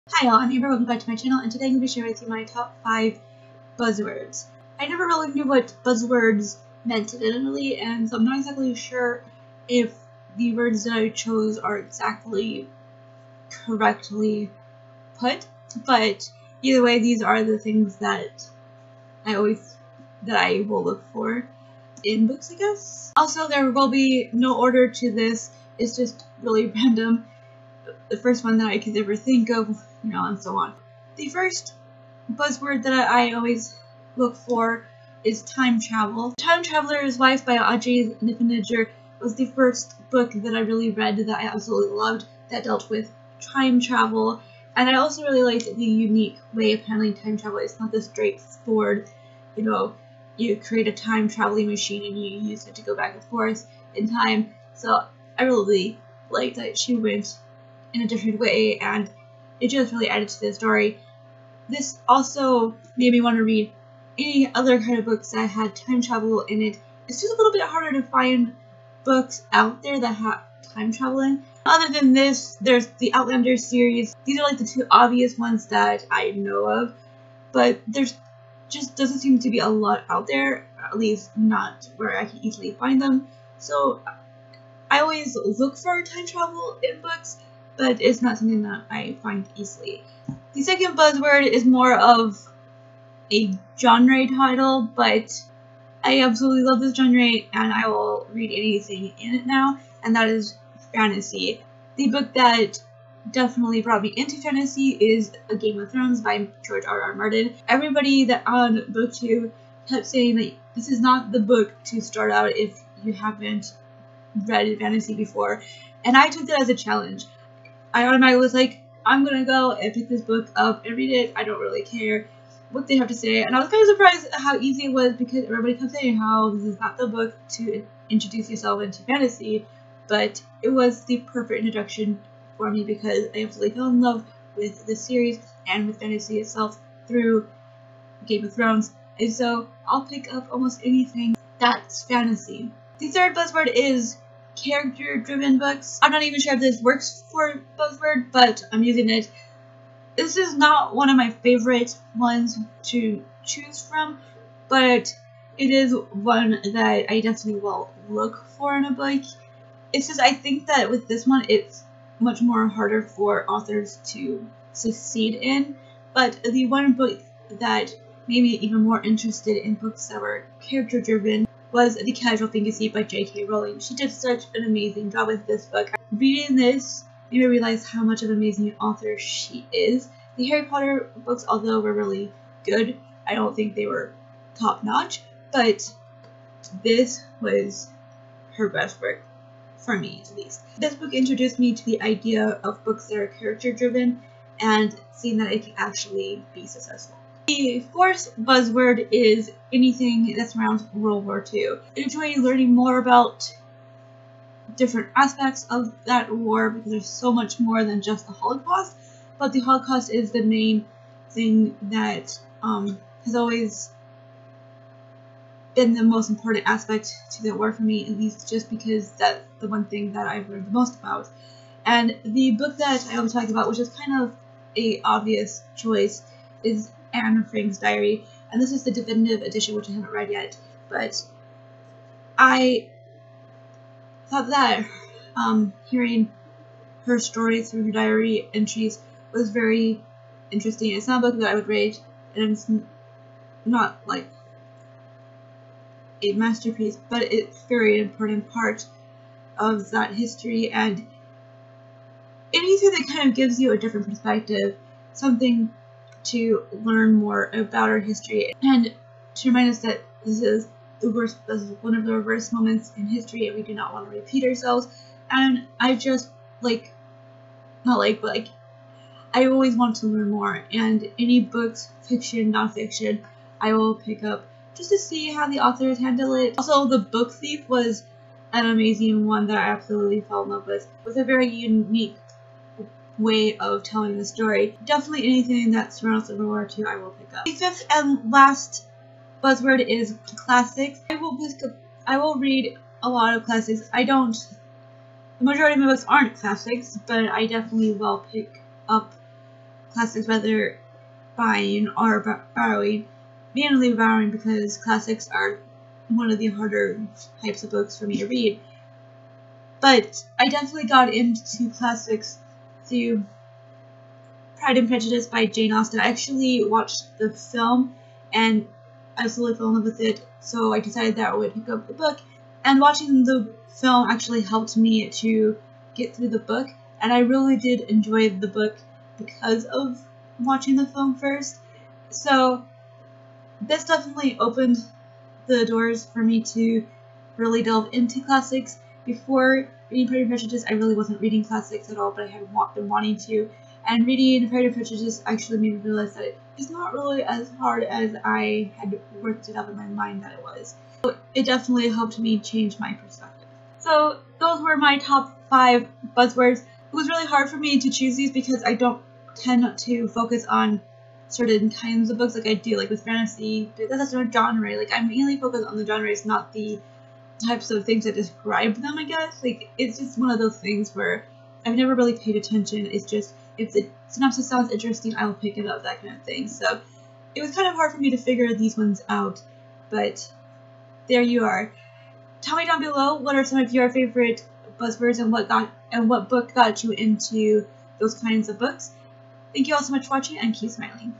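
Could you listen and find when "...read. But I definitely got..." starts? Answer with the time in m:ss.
5:08.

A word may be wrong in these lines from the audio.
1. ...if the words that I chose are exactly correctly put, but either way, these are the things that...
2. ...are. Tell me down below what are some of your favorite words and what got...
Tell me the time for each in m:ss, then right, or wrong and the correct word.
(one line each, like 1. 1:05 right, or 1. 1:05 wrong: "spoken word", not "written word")
1. 0:09 right
2. 6:21 wrong: "buzzwords", not "words".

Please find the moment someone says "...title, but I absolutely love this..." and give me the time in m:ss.
1:34.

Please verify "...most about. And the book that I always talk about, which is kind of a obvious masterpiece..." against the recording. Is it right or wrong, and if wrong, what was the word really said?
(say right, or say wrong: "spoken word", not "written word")
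wrong: "choice", not "masterpiece".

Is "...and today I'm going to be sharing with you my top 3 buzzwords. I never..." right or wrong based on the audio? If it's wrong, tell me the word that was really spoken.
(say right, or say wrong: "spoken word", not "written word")
wrong: "5", not "3".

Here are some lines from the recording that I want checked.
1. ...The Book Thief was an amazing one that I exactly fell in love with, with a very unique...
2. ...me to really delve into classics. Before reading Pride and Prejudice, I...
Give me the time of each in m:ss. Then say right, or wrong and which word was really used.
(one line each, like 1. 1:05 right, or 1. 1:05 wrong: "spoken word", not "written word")
1. 4:36 wrong: "absolutely", not "exactly"
2. 5:36 right.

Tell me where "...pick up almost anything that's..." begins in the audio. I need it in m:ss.
2:20.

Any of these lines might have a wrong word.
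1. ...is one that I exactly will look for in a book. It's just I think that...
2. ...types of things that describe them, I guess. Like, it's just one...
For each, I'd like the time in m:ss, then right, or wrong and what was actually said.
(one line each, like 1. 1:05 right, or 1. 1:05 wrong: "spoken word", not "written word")
1. 2:35 wrong: "definitely", not "exactly"
2. 6:07 right.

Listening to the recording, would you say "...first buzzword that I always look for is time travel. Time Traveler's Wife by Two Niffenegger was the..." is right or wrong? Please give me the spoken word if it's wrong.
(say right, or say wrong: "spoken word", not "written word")
wrong: "Audrey", not "Two".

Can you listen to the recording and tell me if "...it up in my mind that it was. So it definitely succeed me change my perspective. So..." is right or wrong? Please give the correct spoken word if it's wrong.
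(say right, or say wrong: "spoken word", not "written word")
wrong: "helped", not "succeed".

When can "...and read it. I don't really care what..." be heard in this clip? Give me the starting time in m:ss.
2:00.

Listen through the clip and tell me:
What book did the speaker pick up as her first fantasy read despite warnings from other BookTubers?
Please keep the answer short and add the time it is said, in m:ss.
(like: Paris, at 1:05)
A Game of Thrones, at 1:45.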